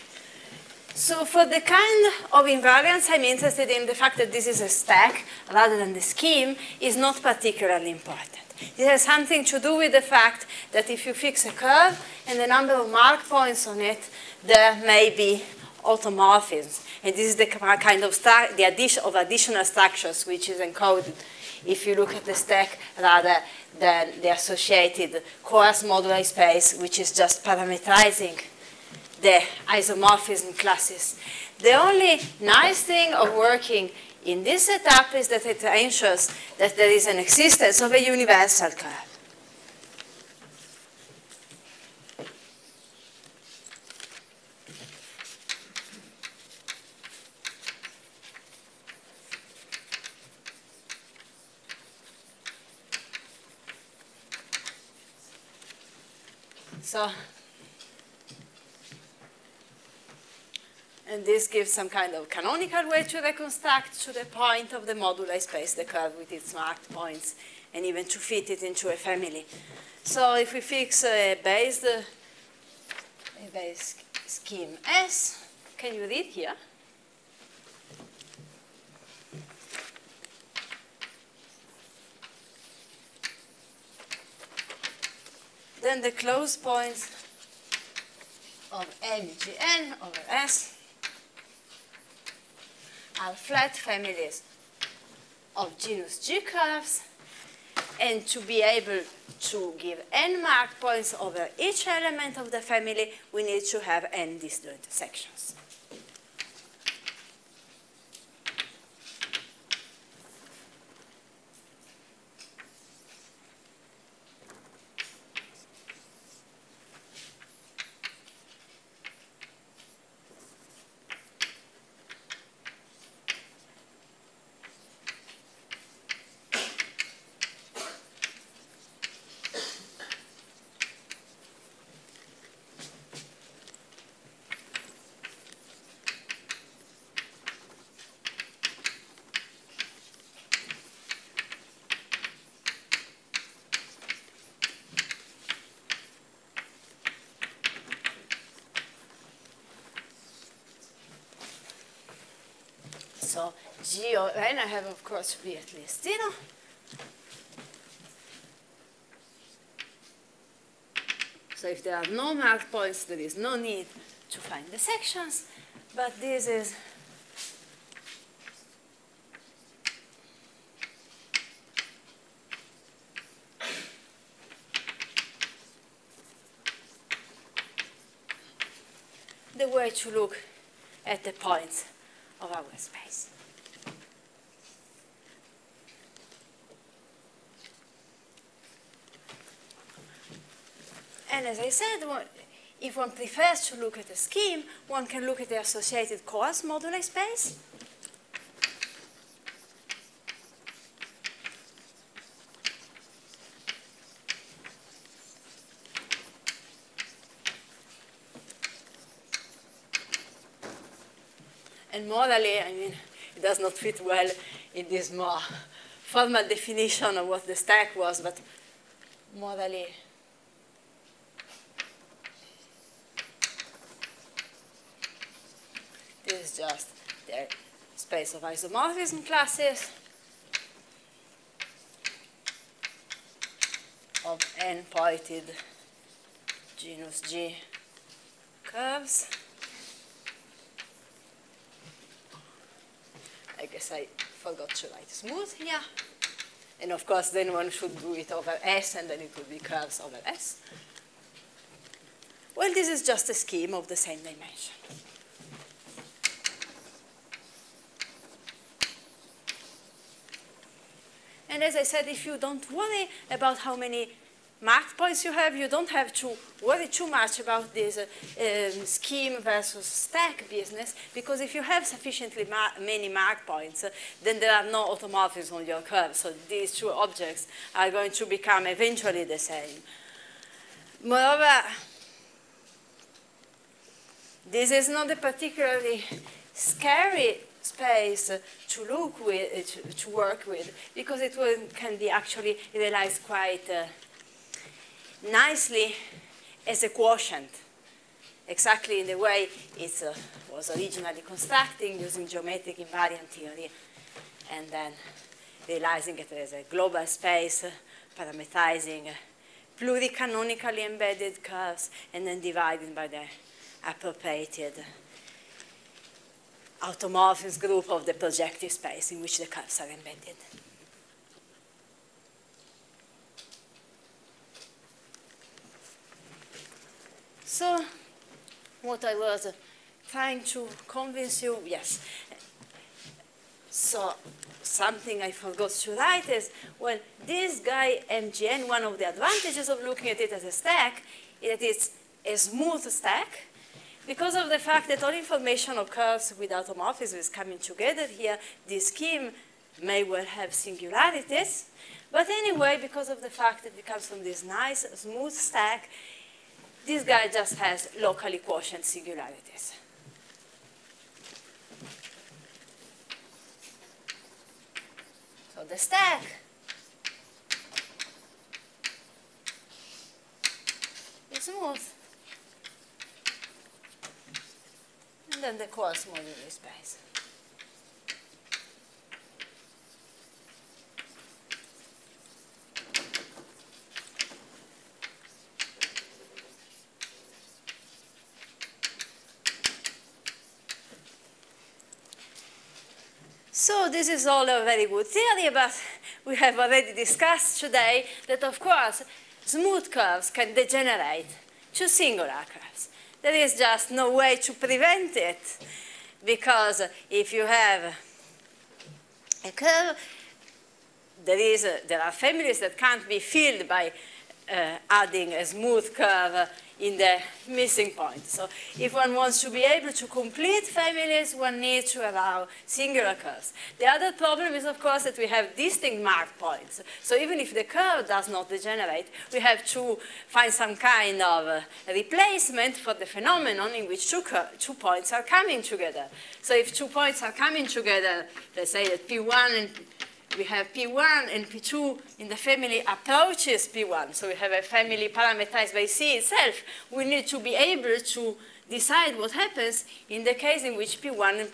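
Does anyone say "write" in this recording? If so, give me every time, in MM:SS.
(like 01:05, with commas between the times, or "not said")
04:04, 05:35.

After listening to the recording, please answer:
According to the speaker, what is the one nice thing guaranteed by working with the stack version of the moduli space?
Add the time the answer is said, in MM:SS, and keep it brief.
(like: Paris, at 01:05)
Existence of a universal curve, at 00:37.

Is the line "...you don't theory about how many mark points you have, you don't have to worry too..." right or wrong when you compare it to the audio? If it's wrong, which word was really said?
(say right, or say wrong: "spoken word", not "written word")
wrong: "worry", not "theory".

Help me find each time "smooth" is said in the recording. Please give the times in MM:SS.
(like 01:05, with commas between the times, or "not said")
04:05, 05:42, 05:54, 06:11, 06:39, 06:55.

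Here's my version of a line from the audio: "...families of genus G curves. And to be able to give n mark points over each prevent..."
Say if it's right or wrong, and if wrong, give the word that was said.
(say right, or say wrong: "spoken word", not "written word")
wrong: "element", not "prevent".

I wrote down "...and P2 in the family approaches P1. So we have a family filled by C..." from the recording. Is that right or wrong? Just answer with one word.
wrong.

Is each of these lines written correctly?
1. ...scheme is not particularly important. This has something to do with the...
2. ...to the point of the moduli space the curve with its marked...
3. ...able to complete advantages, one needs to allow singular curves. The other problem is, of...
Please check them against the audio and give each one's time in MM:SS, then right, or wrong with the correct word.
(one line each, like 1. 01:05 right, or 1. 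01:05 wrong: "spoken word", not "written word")
1. 00:06 right
2. 01:04 right
3. 06:59 wrong: "families", not "advantages".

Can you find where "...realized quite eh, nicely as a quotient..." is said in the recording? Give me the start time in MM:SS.
04:52.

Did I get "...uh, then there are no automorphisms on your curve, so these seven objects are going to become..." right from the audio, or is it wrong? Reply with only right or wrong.
wrong.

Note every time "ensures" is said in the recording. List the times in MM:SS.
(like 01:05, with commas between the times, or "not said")
00:35.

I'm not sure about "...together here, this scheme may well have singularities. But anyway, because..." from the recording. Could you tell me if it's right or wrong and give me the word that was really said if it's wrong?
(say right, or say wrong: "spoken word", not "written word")
right.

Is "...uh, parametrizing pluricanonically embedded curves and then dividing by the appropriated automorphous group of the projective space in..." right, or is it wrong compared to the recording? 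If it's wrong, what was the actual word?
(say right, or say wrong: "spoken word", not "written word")
right.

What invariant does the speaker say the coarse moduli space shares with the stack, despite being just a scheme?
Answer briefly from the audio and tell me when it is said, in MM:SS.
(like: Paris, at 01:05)
Same dimension, at 04:13.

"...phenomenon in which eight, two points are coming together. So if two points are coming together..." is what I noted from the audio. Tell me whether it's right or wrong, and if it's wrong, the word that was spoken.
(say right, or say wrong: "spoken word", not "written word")
wrong: "two", not "eight".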